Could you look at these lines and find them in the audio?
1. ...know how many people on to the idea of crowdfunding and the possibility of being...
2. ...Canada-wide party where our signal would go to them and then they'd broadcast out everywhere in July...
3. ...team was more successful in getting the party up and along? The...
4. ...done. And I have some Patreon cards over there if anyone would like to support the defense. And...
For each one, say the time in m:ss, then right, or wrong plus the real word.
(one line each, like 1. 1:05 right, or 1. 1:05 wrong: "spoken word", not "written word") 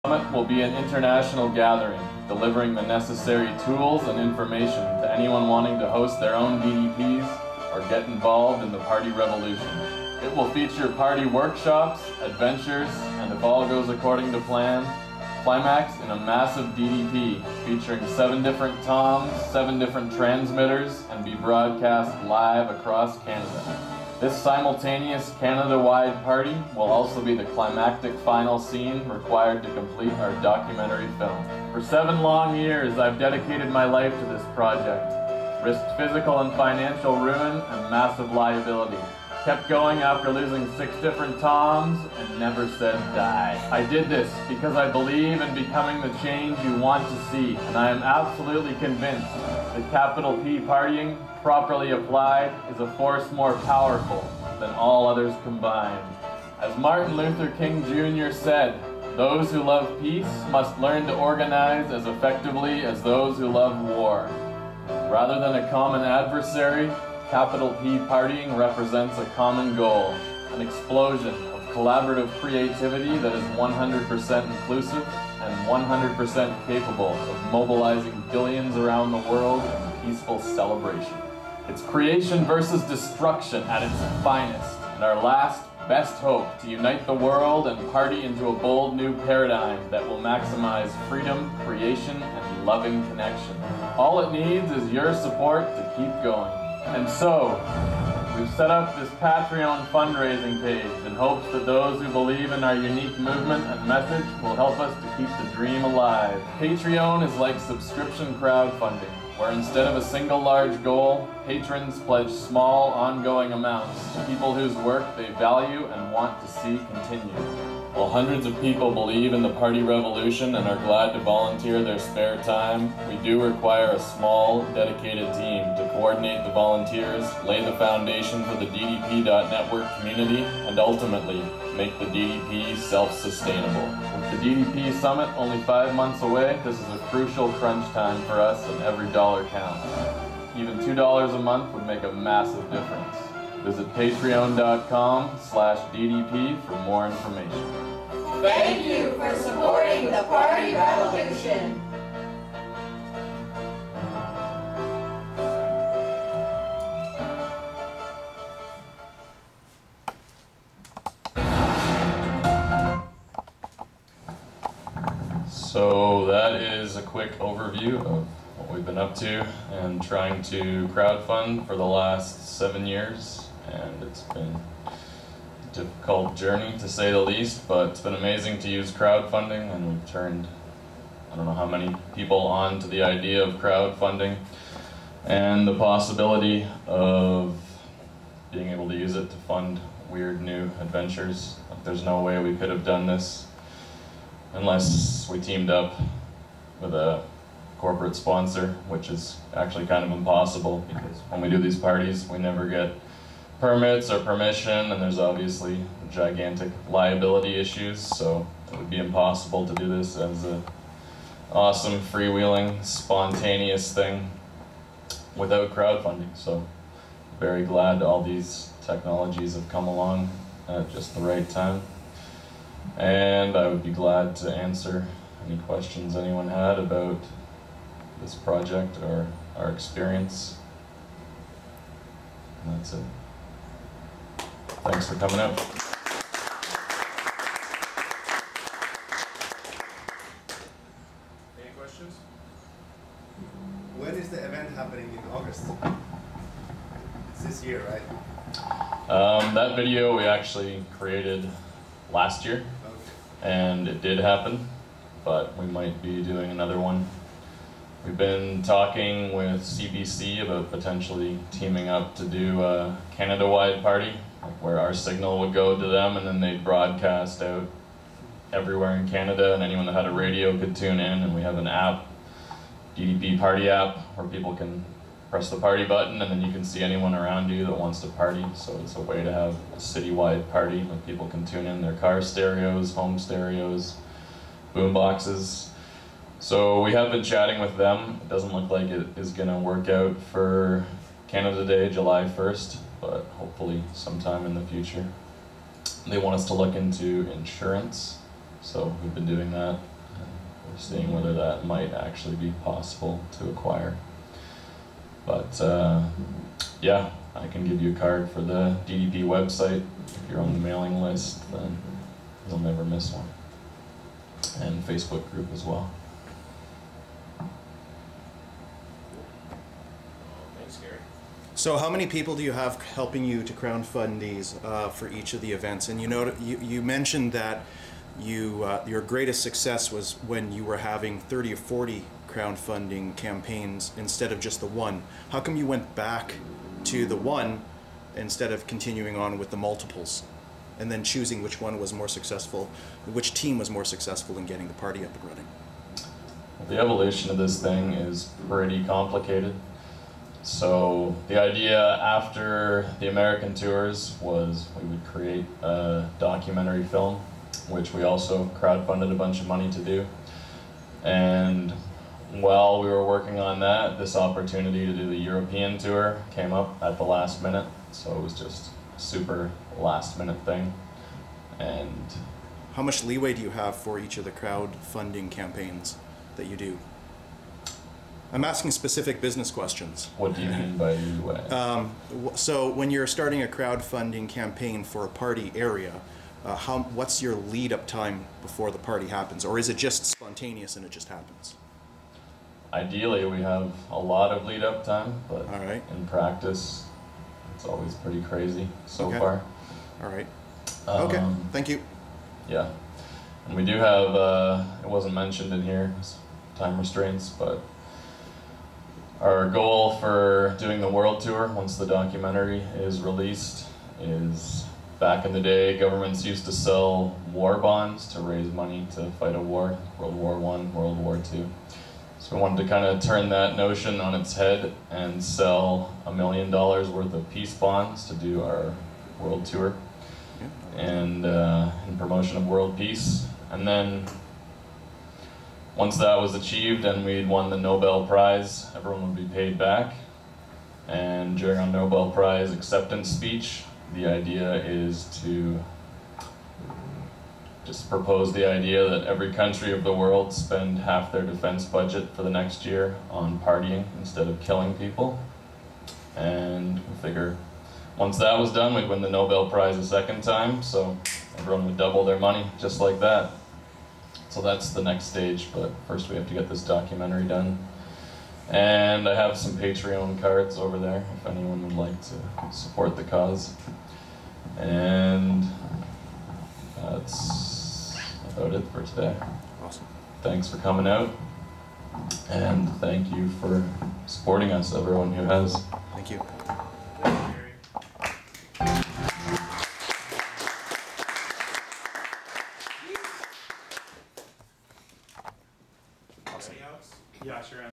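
1. 3:01 right
2. 4:23 wrong: "Canada", not "July"
3. 5:43 wrong: "running", not "along"
4. 7:47 wrong: "cause", not "defense".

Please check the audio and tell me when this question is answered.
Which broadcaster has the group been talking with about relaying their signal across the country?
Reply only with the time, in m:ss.
4:19.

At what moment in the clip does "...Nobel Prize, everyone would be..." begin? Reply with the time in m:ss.
7:17.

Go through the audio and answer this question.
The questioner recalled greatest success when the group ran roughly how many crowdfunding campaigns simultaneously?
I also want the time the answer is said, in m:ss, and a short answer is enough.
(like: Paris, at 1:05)
30 or 40, at 5:31.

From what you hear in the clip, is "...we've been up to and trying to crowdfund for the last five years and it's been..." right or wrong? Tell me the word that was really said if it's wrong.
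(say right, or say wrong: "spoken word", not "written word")
wrong: "seven", not "five".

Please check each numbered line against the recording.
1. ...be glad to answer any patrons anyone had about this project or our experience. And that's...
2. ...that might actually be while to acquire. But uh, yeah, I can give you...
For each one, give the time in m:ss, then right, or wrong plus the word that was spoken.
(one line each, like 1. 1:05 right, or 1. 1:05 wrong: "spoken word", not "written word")
1. 3:43 wrong: "questions", not "patrons"
2. 5:01 wrong: "possible", not "while".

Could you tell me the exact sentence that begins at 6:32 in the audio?
Ideally, we have a lot of lead up time, but in practice, it's always pretty crazy so okay.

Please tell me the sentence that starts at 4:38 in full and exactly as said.
So it's a way to have a citywide party where people can tune in their car stereos, home stereos, boom boxes.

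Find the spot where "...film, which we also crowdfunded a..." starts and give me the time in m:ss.
5:56.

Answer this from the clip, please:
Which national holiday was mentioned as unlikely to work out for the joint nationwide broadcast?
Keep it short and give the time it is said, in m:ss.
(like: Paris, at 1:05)
Canada Day, at 4:51.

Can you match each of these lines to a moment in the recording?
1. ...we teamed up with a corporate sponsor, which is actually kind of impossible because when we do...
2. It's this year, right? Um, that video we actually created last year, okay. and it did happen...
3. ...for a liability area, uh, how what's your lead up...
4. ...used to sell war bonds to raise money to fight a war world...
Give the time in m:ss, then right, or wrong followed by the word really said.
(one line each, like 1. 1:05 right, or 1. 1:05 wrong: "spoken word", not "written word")
1. 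3:15 right
2. 4:07 right
3. 6:24 wrong: "party", not "liability"
4. 6:56 right.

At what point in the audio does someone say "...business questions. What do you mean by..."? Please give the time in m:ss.
6:19.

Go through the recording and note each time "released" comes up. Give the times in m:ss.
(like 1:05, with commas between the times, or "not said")
6:53.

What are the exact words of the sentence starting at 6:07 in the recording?
So it was just a super last minute thing.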